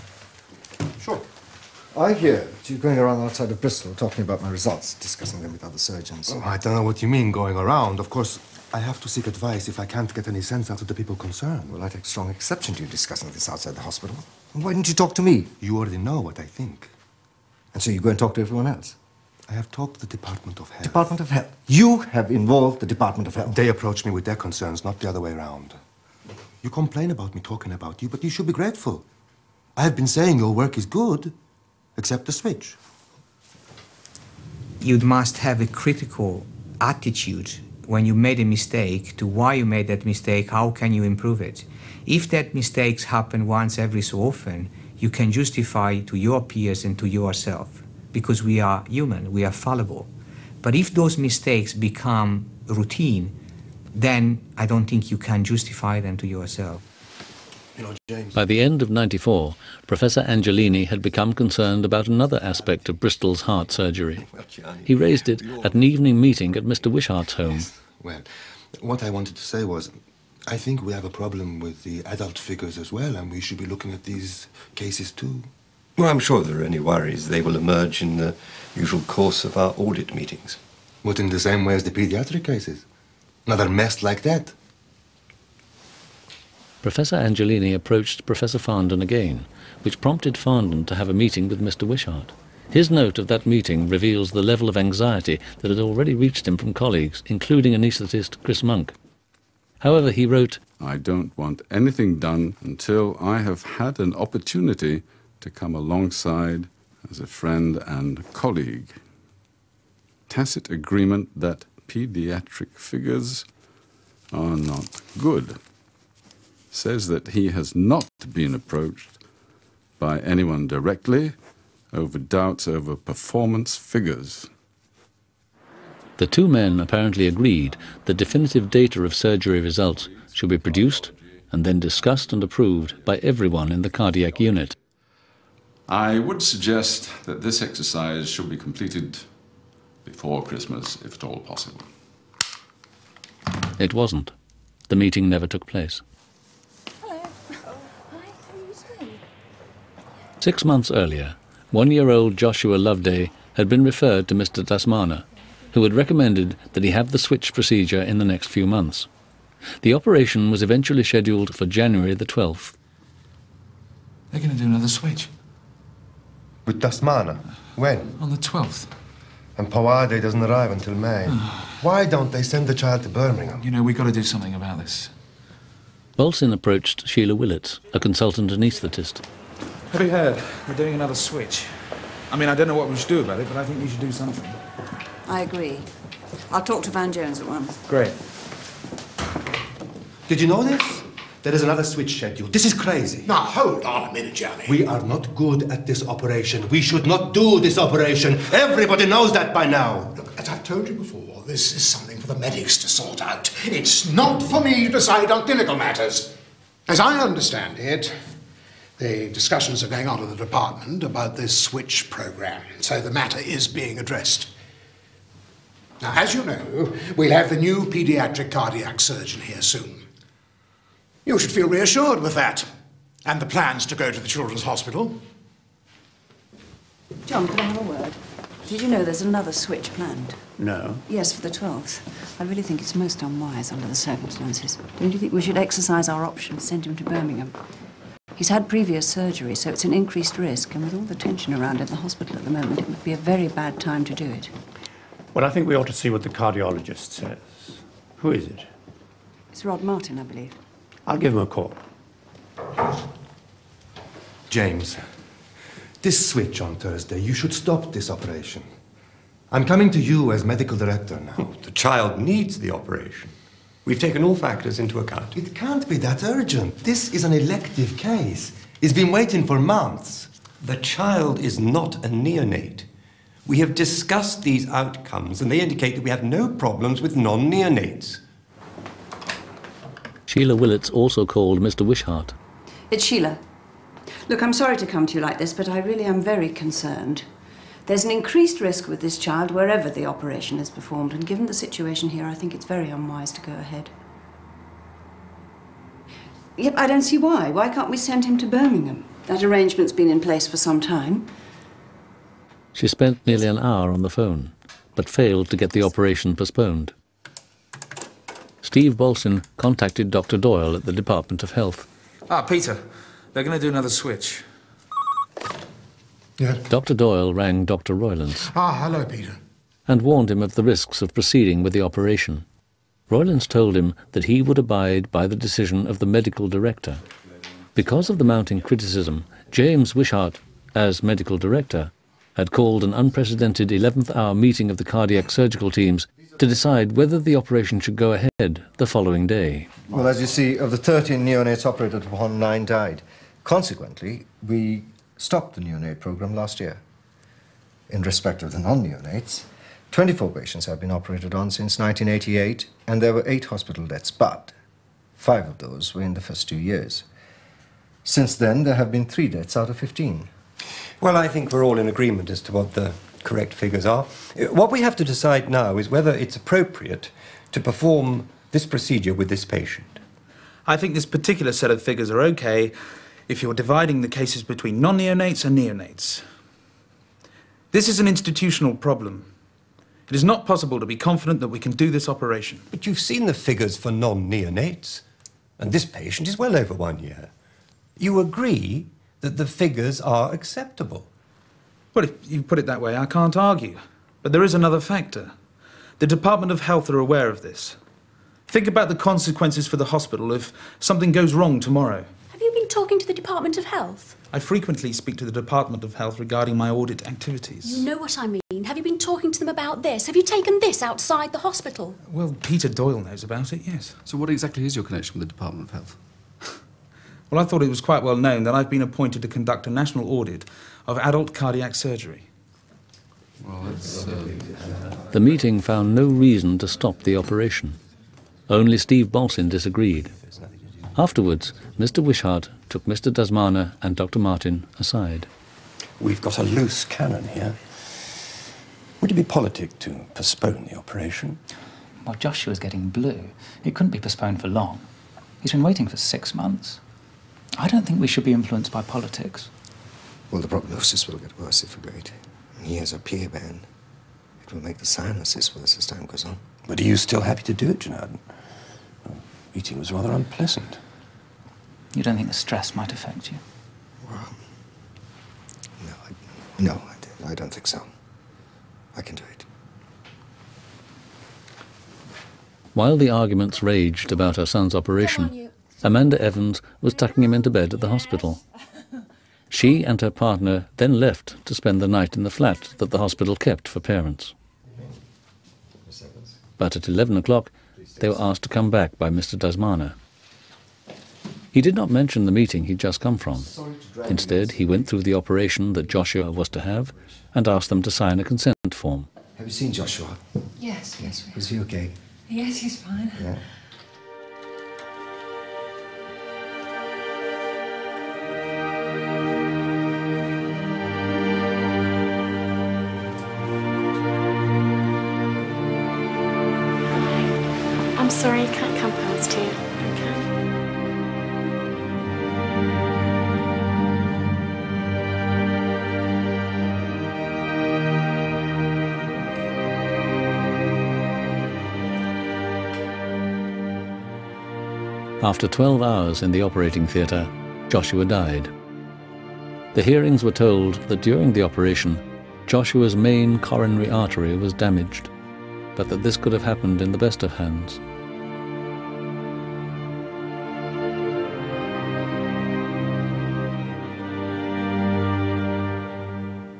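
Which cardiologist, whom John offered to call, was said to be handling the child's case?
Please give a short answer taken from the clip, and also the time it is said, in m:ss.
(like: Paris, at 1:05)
Rod Martin, at 4:09.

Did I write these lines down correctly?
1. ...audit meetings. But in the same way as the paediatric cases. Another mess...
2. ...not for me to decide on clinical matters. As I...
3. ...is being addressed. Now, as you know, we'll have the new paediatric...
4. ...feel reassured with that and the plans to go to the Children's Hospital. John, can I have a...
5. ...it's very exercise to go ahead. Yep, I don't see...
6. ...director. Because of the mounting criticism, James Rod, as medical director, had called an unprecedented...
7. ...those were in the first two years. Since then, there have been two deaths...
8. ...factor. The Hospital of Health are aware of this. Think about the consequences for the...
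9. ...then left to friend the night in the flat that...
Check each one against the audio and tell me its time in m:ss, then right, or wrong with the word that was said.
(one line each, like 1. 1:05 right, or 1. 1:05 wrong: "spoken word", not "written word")
1. 1:19 wrong: "pediatric", not "paediatric"
2. 3:24 right
3. 3:33 right
4. 3:41 right
5. 4:52 wrong: "unwise", not "exercise"
6. 5:26 wrong: "Wishart", not "Rod"
7. 5:55 wrong: "three", not "two"
8. 6:34 wrong: "Department", not "Hospital"
9. 8:00 wrong: "spend", not "friend".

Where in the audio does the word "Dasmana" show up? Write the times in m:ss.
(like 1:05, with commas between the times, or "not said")
2:34, 2:46, 7:13, 8:09.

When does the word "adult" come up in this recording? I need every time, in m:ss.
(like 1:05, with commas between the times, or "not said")
1:12, 7:00.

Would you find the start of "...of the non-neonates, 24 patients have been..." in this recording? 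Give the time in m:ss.
5:48.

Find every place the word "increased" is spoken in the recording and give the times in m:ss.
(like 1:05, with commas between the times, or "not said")
3:59, 4:48.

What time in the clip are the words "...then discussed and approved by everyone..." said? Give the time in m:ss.
2:11.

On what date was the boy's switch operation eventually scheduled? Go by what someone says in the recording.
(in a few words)
January 12.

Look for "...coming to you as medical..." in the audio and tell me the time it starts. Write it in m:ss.
4:19.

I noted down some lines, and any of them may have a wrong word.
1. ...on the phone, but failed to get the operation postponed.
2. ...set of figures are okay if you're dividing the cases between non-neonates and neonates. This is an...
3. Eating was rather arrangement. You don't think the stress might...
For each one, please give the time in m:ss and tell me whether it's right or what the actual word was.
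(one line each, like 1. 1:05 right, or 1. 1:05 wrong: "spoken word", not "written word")
1. 5:03 right
2. 6:11 right
3. 7:39 wrong: "unpleasant", not "arrangement".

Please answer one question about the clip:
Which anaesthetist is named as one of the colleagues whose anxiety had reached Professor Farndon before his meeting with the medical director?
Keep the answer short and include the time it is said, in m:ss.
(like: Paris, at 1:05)
Chris Monk, at 1:38.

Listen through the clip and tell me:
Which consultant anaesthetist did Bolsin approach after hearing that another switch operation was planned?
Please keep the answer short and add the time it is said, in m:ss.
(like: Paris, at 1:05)
Sheila Willett, at 2:57.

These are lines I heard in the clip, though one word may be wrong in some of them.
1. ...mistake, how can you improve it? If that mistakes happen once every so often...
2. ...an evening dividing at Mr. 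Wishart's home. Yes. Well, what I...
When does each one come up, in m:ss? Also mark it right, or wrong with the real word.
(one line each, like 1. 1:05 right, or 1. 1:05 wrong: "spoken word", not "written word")
1. 0:40 right
2. 1:05 wrong: "meeting", not "dividing".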